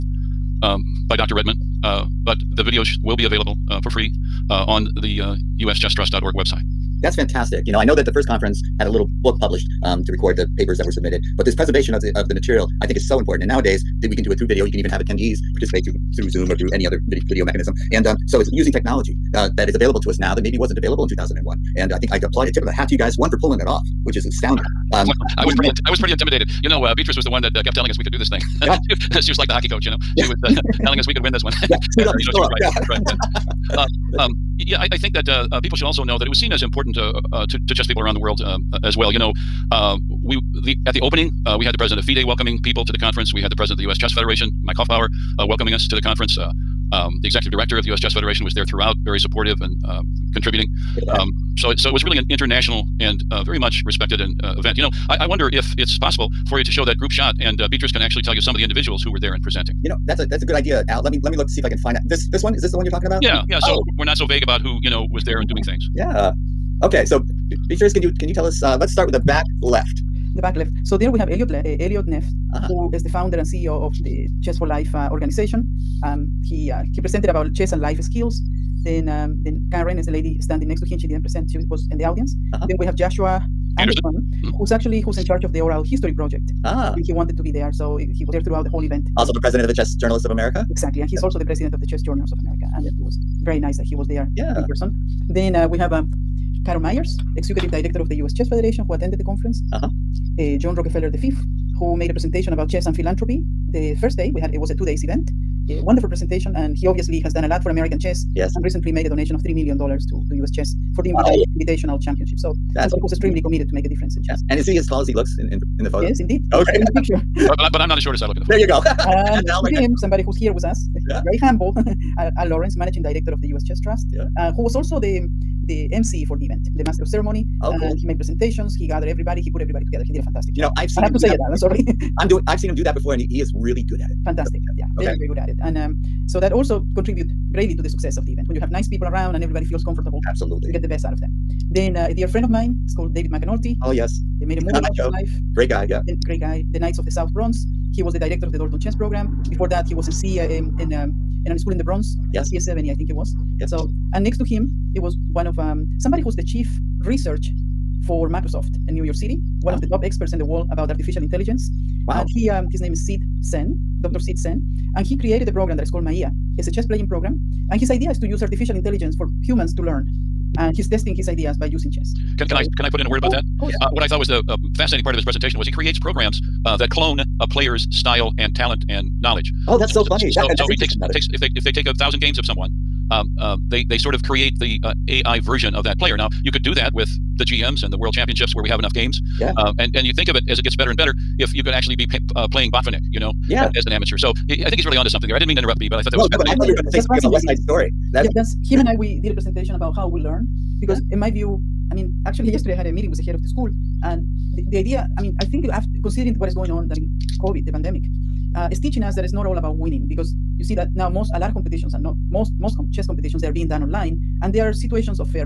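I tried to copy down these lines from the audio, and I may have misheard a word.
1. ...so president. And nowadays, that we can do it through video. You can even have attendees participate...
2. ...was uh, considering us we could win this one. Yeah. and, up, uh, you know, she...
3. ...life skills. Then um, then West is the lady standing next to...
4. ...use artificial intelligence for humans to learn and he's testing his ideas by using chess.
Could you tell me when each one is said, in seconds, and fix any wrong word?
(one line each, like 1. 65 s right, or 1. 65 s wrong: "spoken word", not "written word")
1. 13 s wrong: "important", not "president"
2. 30 s wrong: "telling", not "considering"
3. 77 s wrong: "Karen", not "West"
4. 168 s right.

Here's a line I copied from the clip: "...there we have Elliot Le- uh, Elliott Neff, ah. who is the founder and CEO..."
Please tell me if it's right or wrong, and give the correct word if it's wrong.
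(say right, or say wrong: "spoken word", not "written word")
right.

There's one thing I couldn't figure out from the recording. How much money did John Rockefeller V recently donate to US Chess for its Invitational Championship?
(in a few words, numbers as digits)
$3 million.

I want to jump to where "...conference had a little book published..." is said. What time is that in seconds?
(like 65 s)
8 s.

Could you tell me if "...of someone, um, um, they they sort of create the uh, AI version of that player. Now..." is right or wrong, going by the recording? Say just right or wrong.
right.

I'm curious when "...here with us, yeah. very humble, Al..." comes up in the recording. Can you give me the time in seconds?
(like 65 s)
120 s.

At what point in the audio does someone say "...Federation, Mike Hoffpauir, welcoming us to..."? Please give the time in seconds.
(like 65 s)
44 s.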